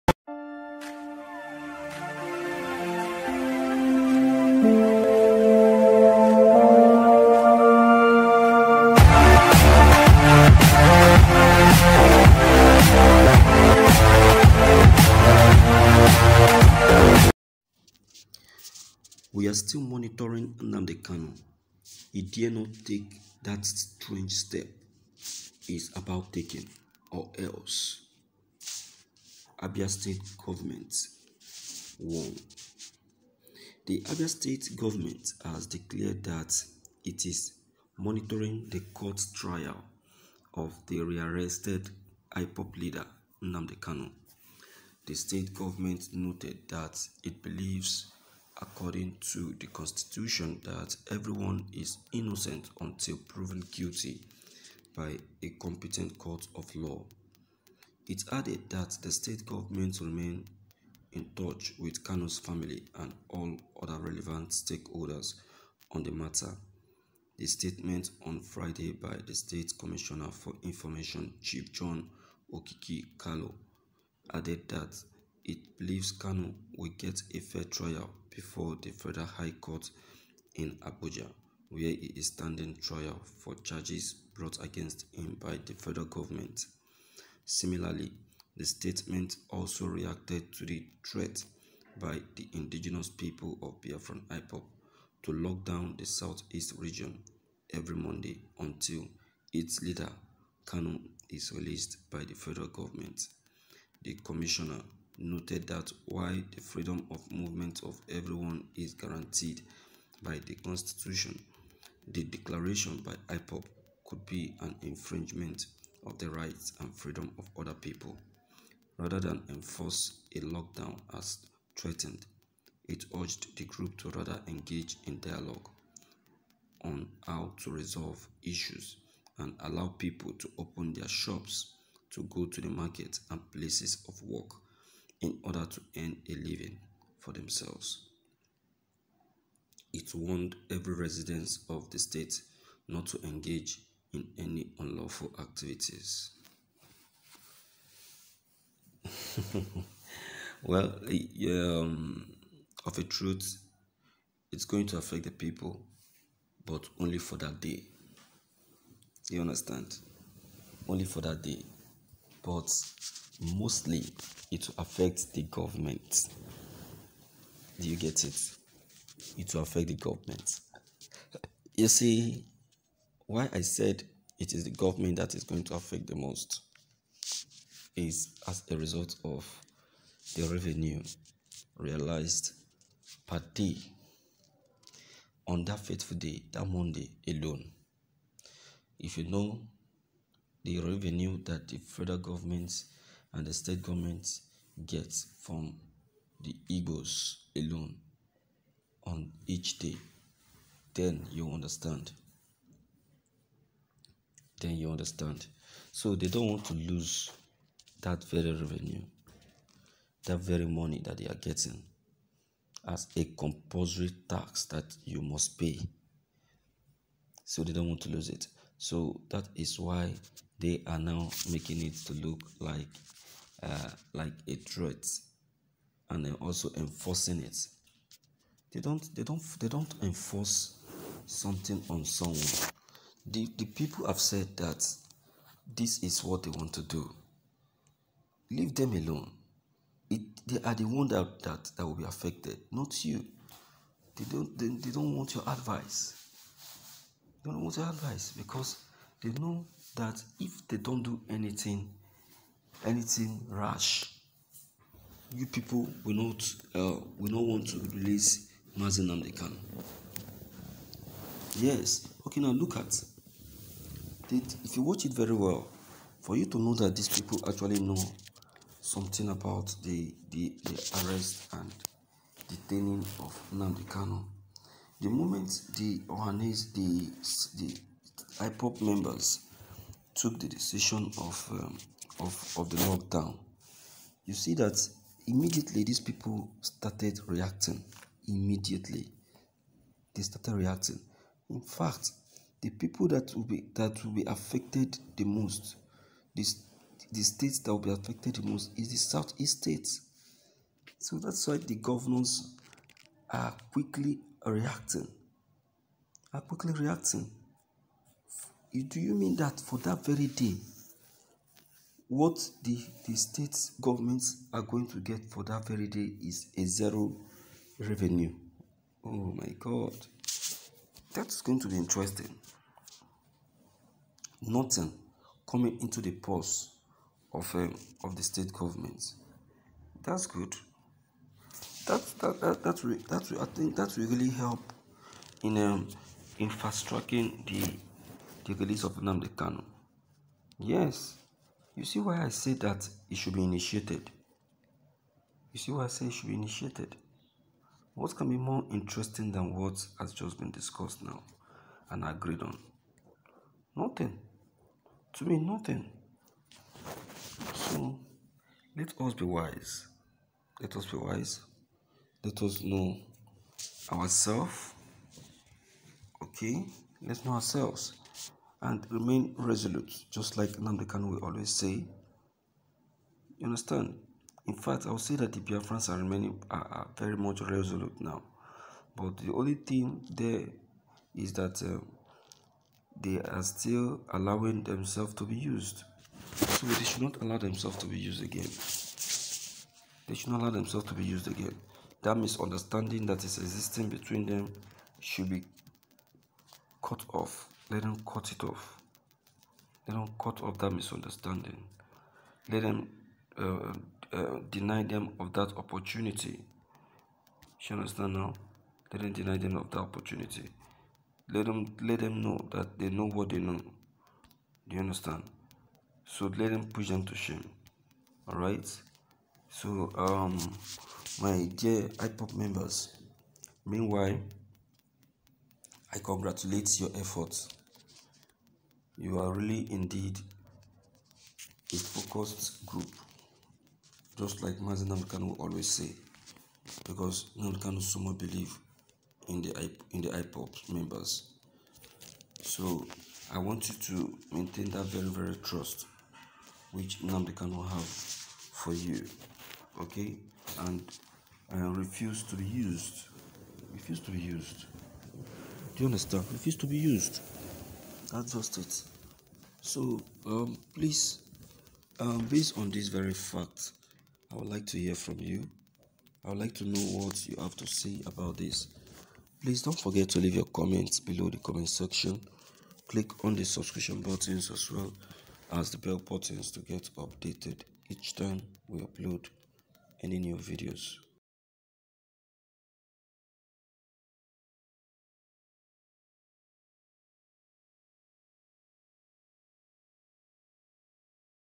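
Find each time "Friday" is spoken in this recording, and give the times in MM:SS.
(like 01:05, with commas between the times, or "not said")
01:08.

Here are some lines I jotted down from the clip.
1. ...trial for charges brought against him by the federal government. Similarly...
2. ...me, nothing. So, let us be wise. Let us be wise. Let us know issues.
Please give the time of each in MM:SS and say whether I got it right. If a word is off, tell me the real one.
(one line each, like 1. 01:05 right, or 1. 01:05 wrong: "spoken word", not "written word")
1. 01:22 right
2. 05:55 wrong: "ourselves", not "issues".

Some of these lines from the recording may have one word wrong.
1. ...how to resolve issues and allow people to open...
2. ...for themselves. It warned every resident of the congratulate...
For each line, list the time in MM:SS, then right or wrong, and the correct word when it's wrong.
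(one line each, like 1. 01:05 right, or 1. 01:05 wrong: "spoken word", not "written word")
1. 02:07 right
2. 02:17 wrong: "state", not "congratulate".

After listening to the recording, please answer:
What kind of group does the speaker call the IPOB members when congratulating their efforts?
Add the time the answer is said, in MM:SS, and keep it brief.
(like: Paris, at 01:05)
A focused group, at 07:11.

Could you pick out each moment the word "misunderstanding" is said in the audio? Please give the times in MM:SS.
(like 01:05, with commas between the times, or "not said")
06:32, 06:40.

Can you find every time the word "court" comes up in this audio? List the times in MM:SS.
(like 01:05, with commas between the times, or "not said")
00:38, 00:56, 01:19.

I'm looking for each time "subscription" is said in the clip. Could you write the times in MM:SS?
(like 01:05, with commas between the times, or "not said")
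07:53.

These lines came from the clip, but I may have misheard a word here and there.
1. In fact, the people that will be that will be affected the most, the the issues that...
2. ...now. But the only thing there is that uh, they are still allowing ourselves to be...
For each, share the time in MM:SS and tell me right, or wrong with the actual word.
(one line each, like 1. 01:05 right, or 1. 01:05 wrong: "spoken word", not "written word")
1. 04:51 wrong: "states", not "issues"
2. 06:17 wrong: "themselves", not "ourselves".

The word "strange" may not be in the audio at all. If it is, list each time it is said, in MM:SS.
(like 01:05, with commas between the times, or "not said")
00:23.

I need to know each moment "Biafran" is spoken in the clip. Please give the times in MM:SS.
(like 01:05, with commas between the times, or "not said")
01:33, 06:15.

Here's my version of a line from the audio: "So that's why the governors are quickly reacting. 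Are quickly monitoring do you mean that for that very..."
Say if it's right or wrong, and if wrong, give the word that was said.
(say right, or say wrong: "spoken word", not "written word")
wrong: "reacting", not "monitoring".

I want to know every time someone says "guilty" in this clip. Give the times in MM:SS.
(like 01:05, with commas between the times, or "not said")
00:53.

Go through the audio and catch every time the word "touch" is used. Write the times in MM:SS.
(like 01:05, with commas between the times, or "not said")
01:01.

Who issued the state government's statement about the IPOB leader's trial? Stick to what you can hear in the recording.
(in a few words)
John Okiyi Kalu.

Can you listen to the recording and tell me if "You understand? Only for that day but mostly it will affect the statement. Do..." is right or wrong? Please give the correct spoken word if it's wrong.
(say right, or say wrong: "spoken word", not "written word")
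wrong: "government", not "statement".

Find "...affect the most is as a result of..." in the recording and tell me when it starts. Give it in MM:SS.
02:55.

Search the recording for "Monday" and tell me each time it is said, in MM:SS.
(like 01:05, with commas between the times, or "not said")
01:37, 03:06.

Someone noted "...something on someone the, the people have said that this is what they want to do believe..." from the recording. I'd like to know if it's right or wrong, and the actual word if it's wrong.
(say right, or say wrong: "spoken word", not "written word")
wrong: "leave", not "believe".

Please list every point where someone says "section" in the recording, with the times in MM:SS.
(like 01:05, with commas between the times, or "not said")
07:51.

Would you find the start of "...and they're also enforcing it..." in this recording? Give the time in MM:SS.
03:46.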